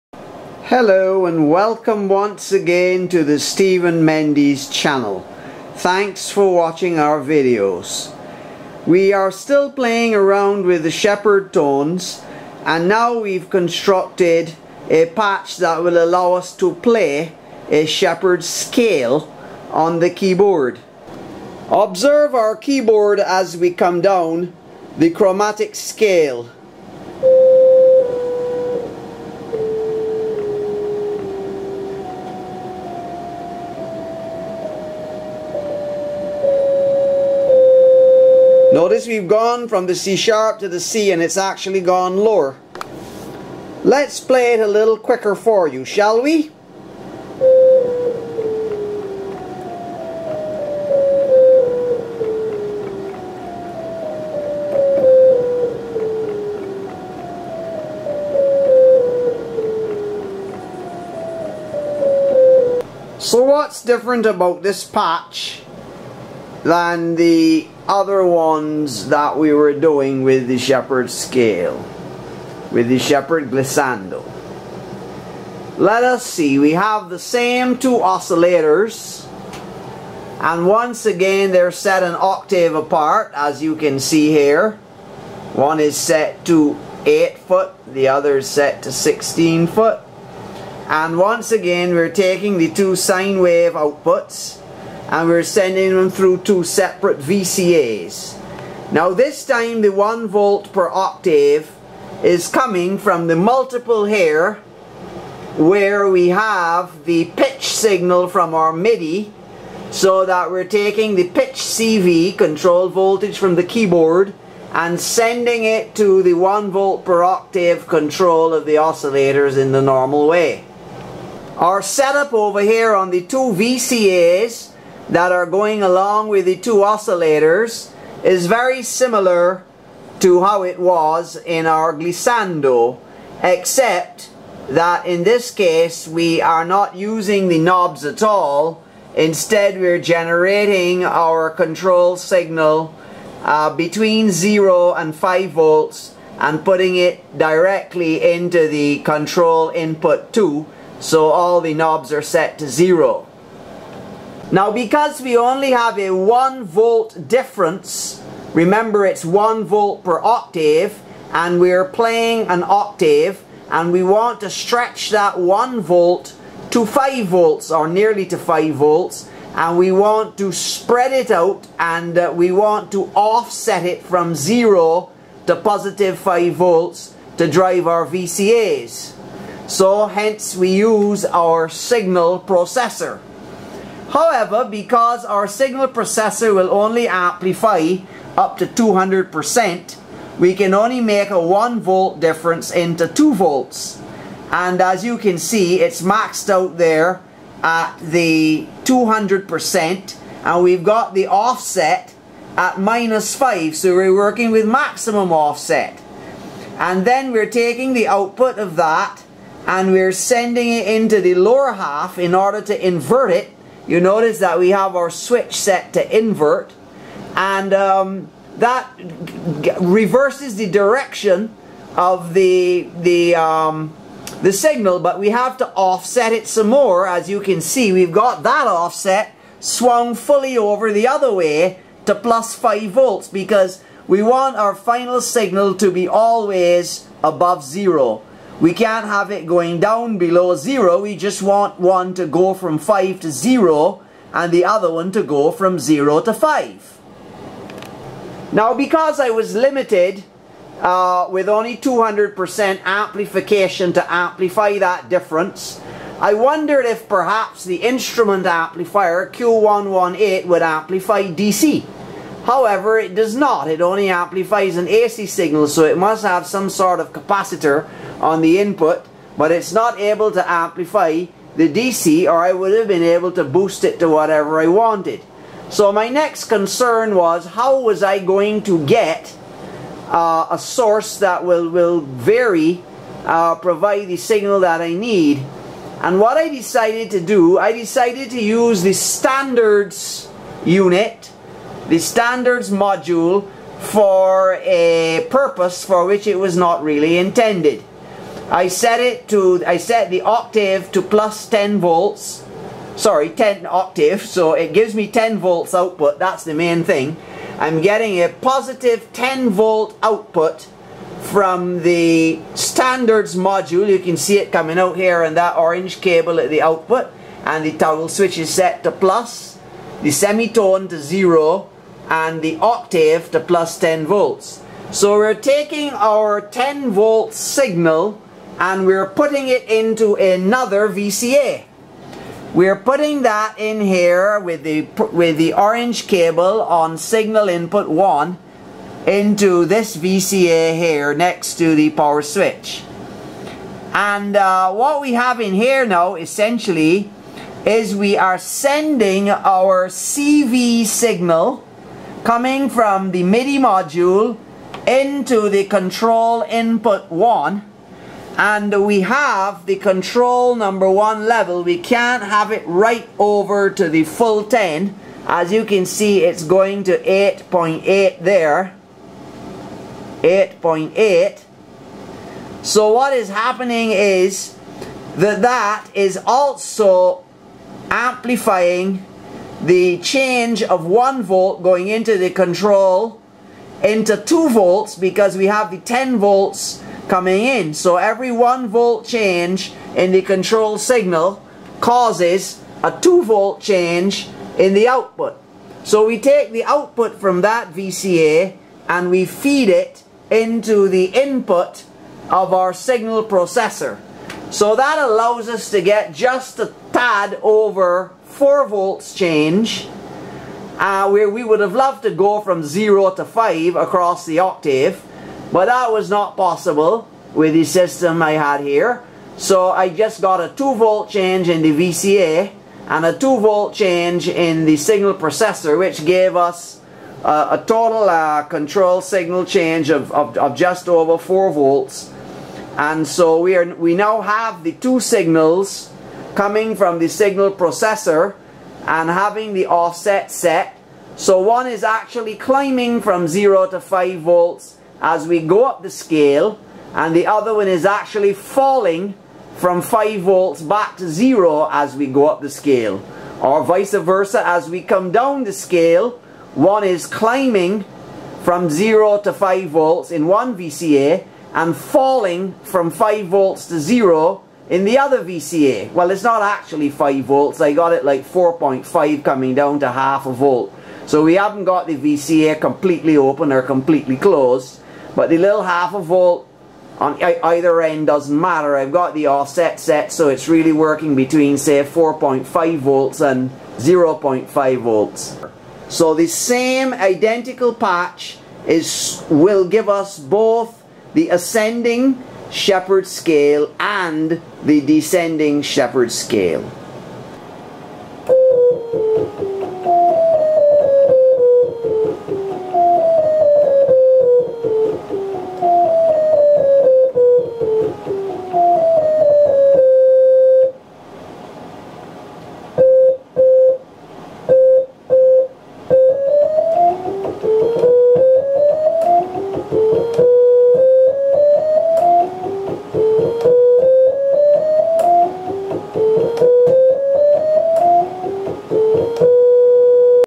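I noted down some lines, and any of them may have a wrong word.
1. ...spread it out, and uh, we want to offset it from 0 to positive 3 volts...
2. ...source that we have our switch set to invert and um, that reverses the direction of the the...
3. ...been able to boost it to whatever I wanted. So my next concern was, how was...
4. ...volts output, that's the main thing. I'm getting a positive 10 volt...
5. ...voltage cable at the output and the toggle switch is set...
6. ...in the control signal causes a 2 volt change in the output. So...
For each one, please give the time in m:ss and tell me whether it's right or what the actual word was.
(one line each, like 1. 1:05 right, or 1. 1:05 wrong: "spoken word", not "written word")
1. 2:50 wrong: "5", not "3"
2. 3:33 wrong: "notice", not "source"
3. 4:32 right
4. 5:05 right
5. 5:15 wrong: "orange", not "voltage"
6. 6:29 right.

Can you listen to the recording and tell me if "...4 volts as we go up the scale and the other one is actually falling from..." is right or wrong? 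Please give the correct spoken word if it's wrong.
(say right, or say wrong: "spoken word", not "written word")
wrong: "5", not "4".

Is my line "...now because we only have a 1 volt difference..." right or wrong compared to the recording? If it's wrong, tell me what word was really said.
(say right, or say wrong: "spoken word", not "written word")
right.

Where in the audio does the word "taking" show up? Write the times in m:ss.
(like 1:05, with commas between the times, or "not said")
1:32, 1:50, 3:27, 5:25.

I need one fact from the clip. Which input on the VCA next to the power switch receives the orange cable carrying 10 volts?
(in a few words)
signal input 1.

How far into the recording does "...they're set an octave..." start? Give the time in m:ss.
1:21.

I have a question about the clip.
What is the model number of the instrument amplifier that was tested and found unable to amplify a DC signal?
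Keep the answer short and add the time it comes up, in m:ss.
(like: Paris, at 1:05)
Q118, at 4:19.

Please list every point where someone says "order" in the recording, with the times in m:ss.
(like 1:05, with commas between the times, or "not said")
3:32.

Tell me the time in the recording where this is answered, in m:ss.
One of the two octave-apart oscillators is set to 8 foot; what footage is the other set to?
1:28.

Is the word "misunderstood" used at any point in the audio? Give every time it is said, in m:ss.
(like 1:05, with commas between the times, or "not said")
not said.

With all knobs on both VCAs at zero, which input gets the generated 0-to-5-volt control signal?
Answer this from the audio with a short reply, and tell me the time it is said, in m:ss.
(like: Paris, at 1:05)
control input 2, at 2:28.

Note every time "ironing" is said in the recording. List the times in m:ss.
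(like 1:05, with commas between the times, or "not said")
not said.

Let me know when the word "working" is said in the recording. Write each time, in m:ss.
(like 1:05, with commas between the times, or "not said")
3:24, 8:00.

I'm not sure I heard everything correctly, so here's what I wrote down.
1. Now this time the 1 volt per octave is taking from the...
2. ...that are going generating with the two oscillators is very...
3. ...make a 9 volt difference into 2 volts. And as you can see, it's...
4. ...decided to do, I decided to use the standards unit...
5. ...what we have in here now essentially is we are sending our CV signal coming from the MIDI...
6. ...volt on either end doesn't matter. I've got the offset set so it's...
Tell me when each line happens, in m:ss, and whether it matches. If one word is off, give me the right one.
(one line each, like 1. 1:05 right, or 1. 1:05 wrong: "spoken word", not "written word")
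1. 1:38 wrong: "coming", not "taking"
2. 2:05 wrong: "along", not "generating"
3. 3:10 wrong: "1", not "9"
4. 4:46 right
5. 5:44 right
6. 7:55 right.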